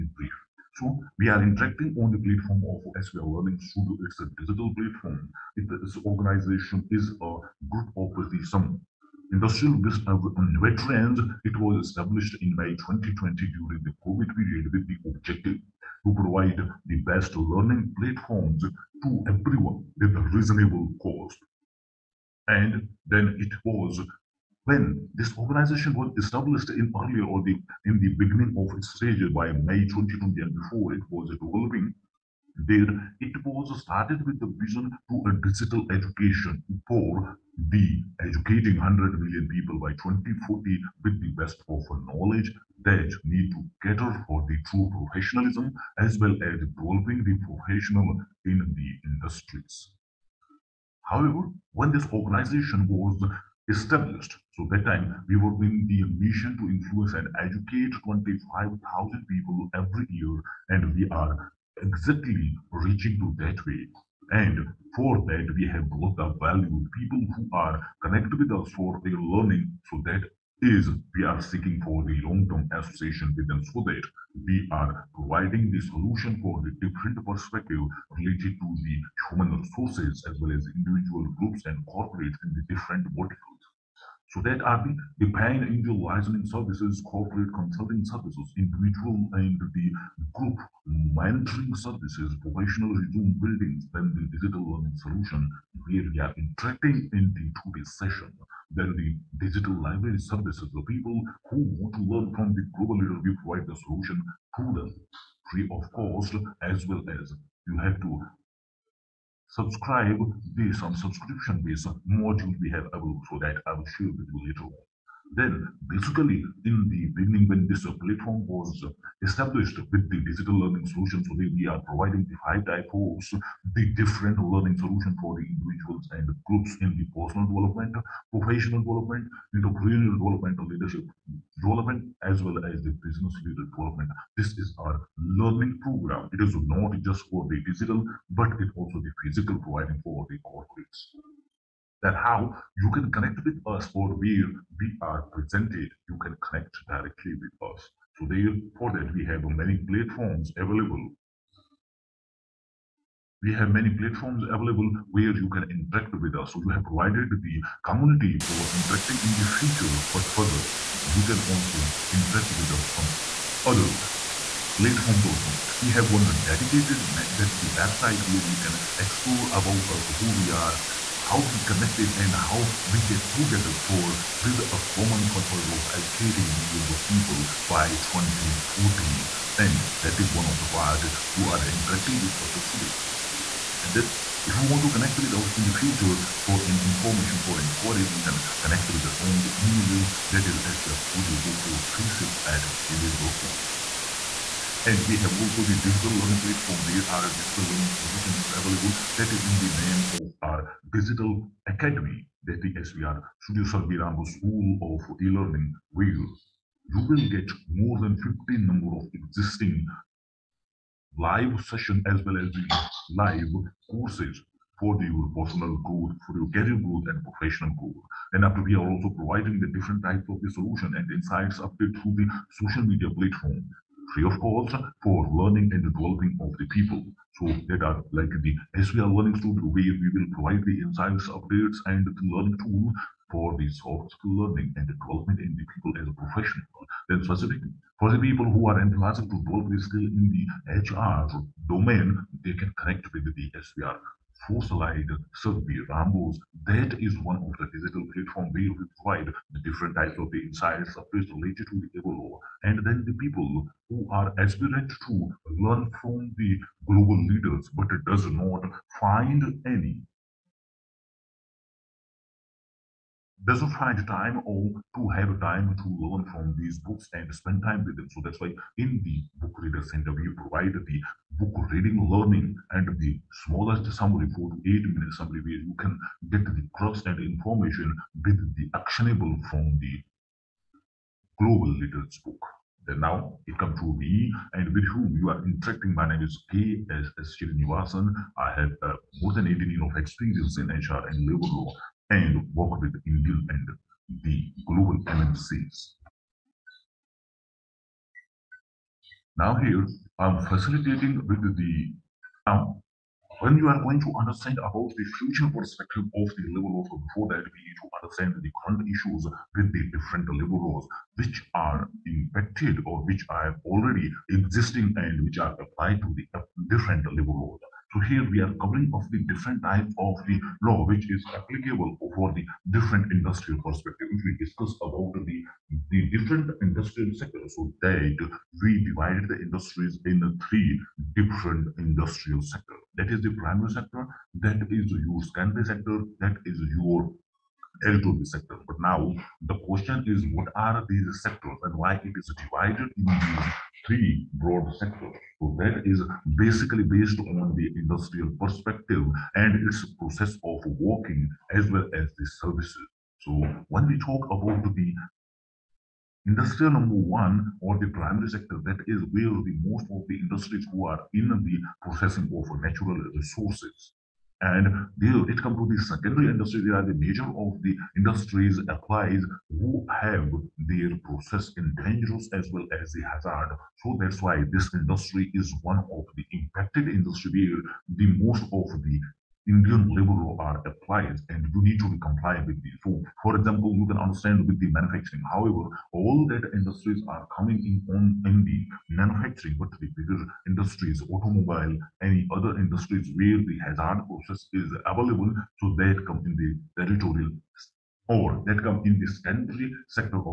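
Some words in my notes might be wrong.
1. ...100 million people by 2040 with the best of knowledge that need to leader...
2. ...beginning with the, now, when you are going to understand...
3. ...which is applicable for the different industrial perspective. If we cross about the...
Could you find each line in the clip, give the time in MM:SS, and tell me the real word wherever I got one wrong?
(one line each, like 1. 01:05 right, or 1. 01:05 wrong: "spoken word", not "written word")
1. 00:38 wrong: "cater", not "leader"
2. 05:00 wrong: "facilitating", not "beginning"
3. 05:20 wrong: "discuss", not "cross".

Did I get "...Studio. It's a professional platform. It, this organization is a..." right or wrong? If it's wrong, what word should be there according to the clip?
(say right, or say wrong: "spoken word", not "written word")
wrong: "digital", not "professional".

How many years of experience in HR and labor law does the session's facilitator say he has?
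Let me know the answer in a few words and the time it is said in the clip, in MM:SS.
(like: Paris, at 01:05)
18, at 04:49.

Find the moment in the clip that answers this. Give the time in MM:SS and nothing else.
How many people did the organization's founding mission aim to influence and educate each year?
00:58.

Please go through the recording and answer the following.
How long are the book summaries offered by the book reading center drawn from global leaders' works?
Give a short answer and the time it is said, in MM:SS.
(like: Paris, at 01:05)
8 minutes, at 04:34.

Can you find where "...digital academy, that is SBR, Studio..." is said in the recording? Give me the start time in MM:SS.
03:20.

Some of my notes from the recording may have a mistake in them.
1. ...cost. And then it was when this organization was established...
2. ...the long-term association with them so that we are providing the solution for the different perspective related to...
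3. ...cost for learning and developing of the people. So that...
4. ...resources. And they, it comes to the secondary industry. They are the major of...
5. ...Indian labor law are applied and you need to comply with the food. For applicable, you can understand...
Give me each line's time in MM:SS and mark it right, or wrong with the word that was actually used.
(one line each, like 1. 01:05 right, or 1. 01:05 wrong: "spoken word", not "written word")
1. 00:21 right
2. 01:12 right
3. 03:44 right
4. 06:03 right
5. 06:19 wrong: "example", not "applicable".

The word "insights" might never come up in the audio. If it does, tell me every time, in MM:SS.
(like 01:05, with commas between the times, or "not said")
03:41, 03:50, 04:10.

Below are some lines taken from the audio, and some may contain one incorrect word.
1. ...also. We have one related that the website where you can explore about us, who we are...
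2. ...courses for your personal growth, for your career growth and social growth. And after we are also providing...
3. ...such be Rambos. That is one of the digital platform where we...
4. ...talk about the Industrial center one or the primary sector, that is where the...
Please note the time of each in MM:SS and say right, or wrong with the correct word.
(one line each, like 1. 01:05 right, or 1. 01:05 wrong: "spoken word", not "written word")
1. 02:45 wrong: "dedicated", not "related"
2. 03:33 wrong: "professional", not "social"
3. 04:05 right
4. 05:53 wrong: "number", not "center".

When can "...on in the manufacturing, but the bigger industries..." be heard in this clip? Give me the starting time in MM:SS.
06:27.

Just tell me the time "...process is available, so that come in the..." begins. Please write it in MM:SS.
06:34.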